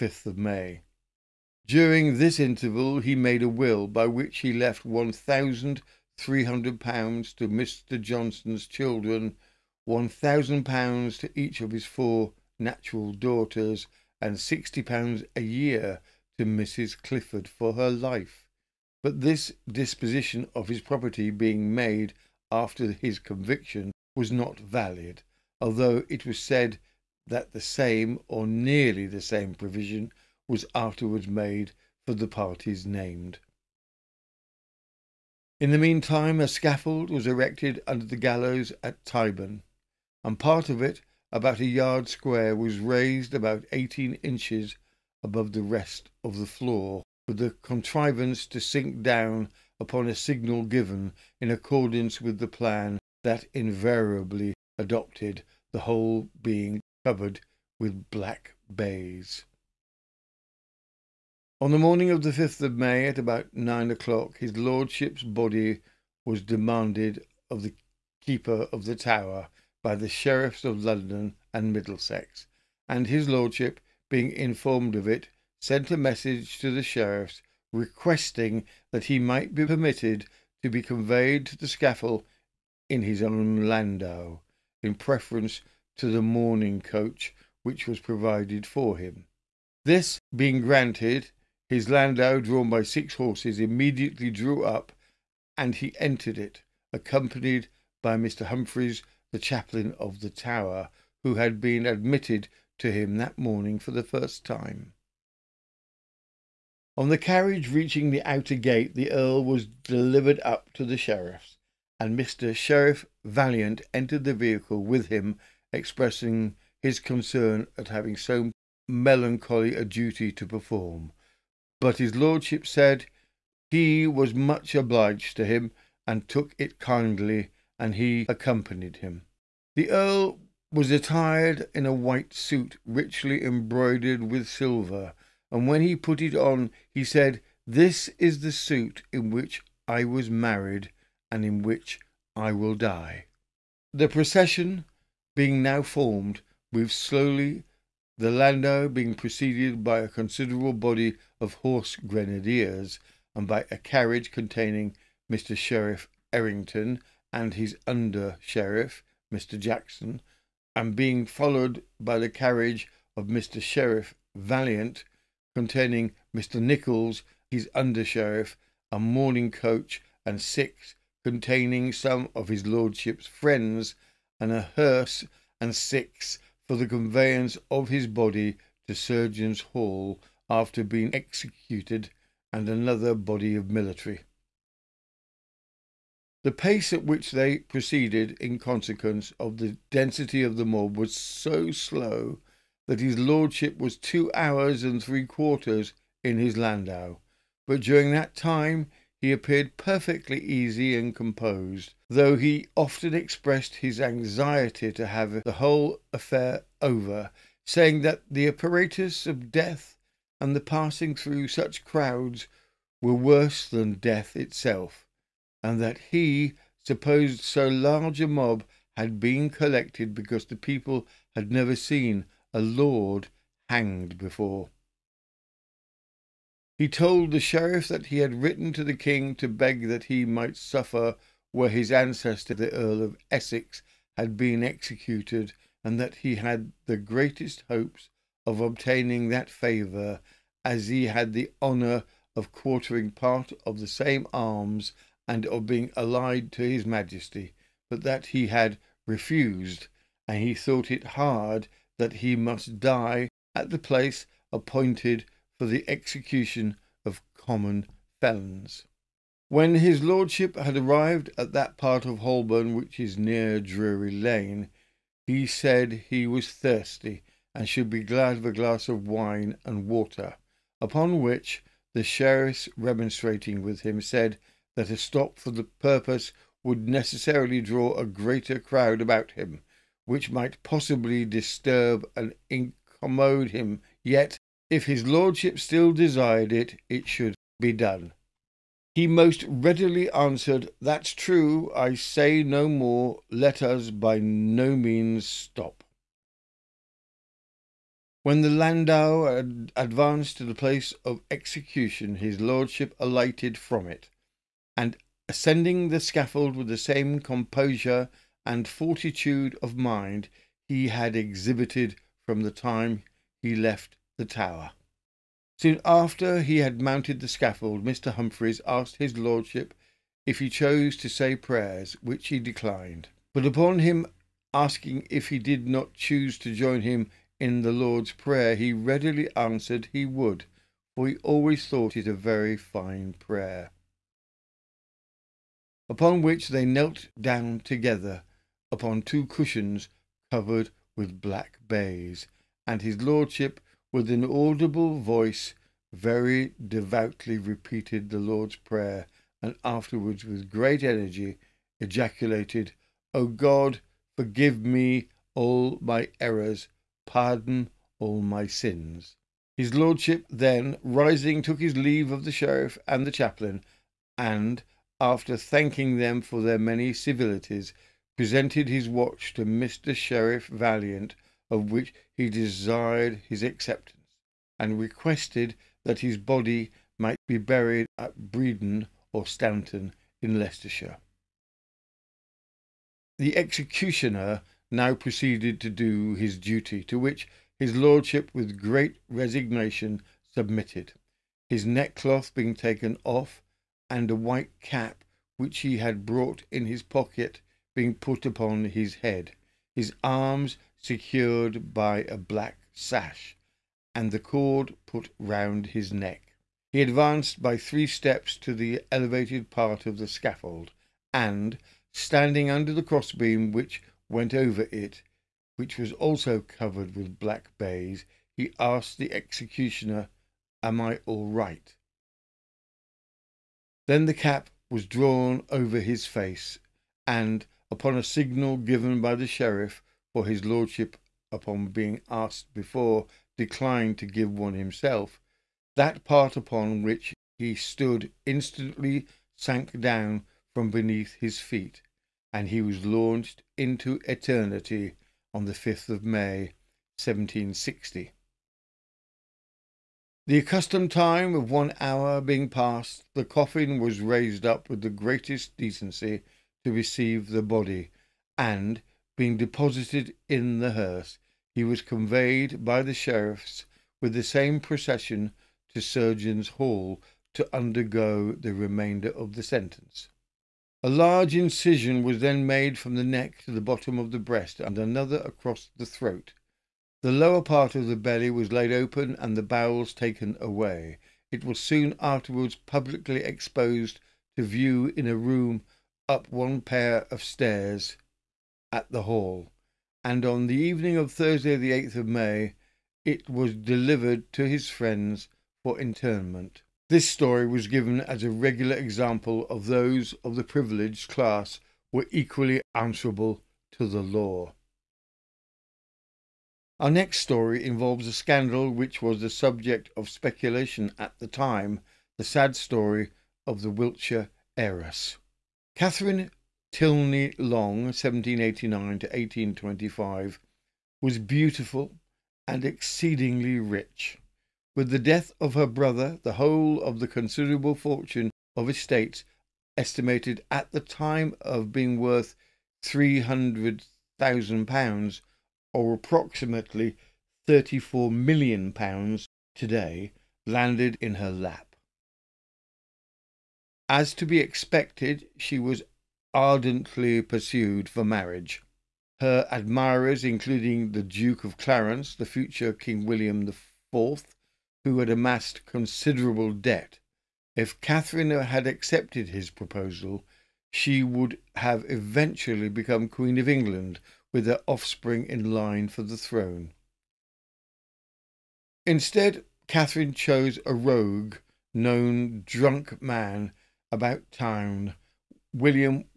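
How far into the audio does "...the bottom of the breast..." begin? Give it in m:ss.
7:53.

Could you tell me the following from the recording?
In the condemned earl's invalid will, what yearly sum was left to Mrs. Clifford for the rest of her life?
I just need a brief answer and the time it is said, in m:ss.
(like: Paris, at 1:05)
£60 a year, at 0:14.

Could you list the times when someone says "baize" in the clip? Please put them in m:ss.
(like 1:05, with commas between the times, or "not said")
0:58, 5:41, 6:57.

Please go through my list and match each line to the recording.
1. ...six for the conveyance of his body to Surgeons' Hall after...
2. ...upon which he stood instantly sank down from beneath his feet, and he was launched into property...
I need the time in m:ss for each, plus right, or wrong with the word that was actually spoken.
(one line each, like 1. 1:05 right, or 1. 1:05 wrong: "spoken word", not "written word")
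1. 2:55 right
2. 7:16 wrong: "eternity", not "property".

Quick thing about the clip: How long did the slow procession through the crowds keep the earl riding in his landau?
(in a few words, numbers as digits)
2 hours and 45 minutes.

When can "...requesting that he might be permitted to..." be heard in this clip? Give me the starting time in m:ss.
1:17.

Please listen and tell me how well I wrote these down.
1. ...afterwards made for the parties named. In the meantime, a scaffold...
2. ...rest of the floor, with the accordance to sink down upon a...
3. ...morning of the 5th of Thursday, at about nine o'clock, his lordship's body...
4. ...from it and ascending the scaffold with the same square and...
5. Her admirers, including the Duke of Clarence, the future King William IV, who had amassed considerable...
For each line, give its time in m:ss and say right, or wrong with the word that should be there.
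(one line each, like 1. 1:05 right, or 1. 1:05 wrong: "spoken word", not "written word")
1. 0:30 right
2. 0:45 wrong: "contrivance", not "accordance"
3. 1:01 wrong: "May", not "Thursday"
4. 5:03 wrong: "composure", not "square"
5. 9:09 right.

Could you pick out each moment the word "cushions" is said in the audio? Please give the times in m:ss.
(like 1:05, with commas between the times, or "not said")
5:39.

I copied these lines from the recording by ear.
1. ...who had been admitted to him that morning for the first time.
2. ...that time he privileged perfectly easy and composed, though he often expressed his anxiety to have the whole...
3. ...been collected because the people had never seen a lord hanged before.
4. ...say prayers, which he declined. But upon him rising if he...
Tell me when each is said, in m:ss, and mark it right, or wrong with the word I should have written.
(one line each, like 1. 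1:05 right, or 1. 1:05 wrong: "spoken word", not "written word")
1. 1:41 right
2. 3:18 wrong: "appeared", not "privileged"
3. 3:39 right
4. 5:21 wrong: "asking", not "rising".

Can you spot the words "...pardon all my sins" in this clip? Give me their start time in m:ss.
5:57.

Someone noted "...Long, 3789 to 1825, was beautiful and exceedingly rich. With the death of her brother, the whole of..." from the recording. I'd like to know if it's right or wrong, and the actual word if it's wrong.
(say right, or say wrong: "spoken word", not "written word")
wrong: "1789", not "3789".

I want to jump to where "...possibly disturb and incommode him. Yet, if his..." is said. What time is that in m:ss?
4:40.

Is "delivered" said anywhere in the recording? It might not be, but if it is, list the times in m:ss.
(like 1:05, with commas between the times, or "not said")
1:49, 8:13.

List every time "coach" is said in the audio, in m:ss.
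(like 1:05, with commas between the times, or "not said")
1:26, 2:49.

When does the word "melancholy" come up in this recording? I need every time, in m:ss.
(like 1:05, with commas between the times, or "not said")
1:58.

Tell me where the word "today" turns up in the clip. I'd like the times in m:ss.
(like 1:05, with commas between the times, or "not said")
8:59.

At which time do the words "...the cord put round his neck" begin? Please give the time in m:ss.
6:44.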